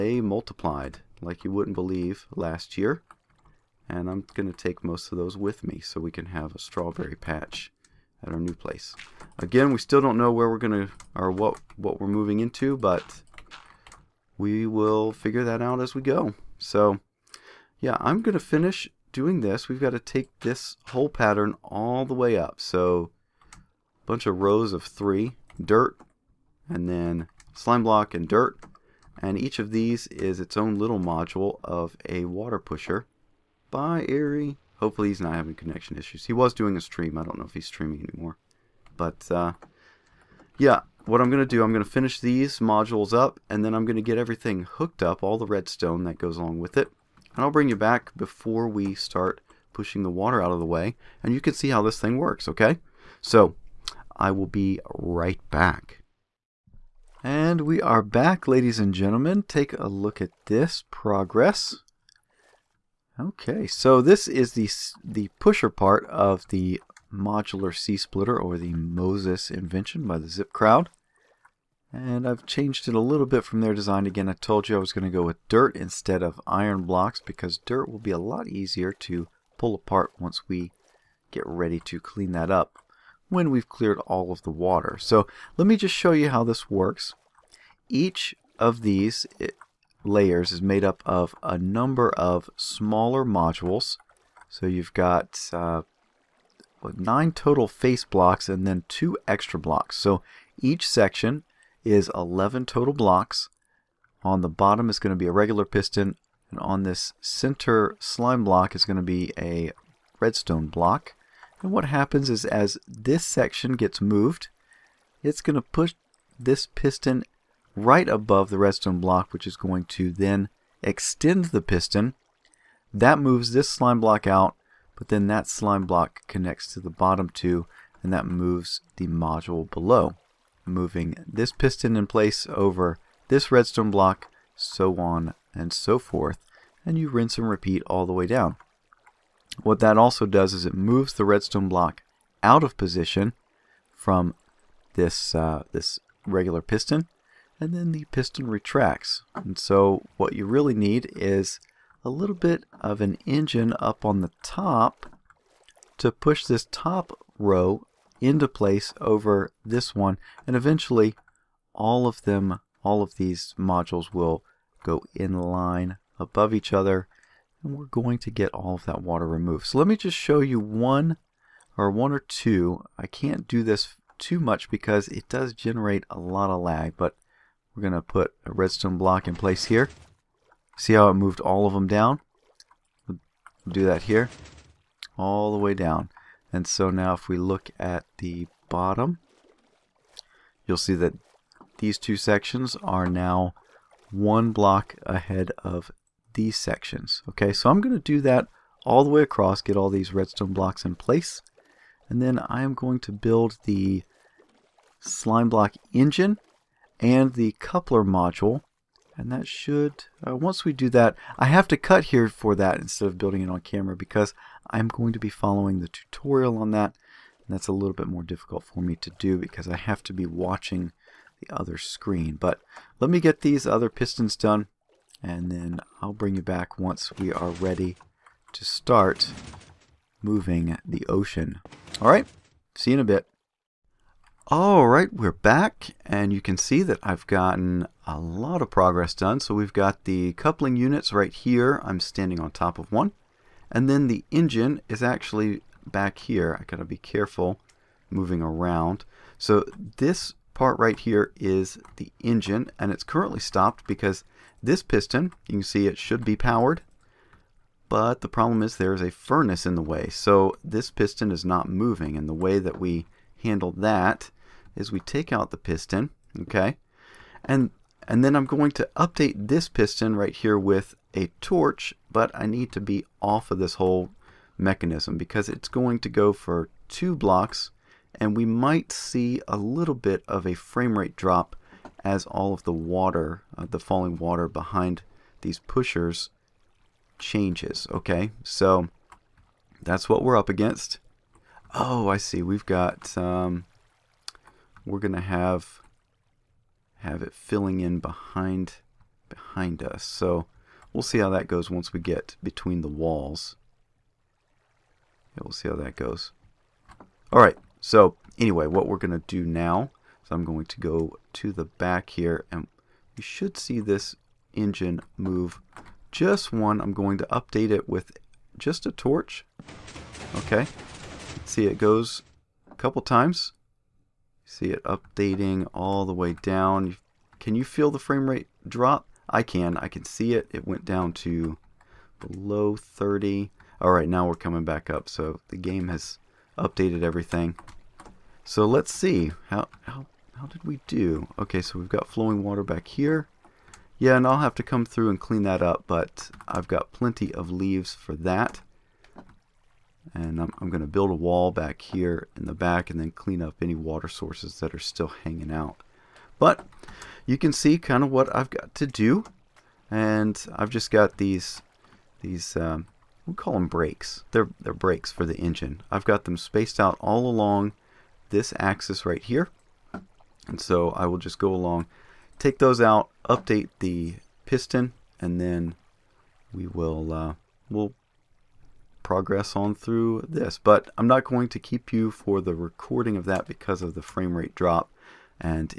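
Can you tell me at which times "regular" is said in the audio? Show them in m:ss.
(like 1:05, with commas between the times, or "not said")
1:45, 2:26.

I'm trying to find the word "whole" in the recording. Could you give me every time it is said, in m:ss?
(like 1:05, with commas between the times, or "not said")
0:20, 4:33.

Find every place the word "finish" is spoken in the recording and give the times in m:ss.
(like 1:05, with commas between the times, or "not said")
0:18, 0:41.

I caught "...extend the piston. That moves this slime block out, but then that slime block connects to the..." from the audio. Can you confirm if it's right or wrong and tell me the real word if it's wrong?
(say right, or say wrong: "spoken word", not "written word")
right.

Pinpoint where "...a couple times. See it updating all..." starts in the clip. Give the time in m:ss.
5:22.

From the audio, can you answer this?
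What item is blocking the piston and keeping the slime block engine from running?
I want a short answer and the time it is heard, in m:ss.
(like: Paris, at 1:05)
A furnace, at 4:19.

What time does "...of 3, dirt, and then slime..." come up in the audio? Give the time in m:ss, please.
0:24.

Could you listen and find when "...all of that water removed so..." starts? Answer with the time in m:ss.
2:48.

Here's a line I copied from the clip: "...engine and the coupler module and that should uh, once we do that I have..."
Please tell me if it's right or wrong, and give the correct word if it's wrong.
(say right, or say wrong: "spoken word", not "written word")
right.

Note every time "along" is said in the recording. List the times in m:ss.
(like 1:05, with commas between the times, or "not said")
0:46, 6:07, 6:11.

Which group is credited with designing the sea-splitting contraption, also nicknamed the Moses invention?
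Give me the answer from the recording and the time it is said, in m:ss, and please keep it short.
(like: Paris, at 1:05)
ZipKrowd, at 1:10.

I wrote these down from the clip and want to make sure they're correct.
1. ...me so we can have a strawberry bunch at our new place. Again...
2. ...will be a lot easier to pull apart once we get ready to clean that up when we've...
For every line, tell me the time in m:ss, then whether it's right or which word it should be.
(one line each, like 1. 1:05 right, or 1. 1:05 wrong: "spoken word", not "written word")
1. 0:05 wrong: "patch", not "bunch"
2. 1:17 right.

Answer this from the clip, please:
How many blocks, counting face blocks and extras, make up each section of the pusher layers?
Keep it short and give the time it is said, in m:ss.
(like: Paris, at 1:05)
11, at 1:42.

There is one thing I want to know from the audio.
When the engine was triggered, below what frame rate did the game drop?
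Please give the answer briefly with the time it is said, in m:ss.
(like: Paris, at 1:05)
30, at 5:32.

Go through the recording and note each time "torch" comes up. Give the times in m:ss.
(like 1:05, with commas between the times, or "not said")
4:31, 5:18.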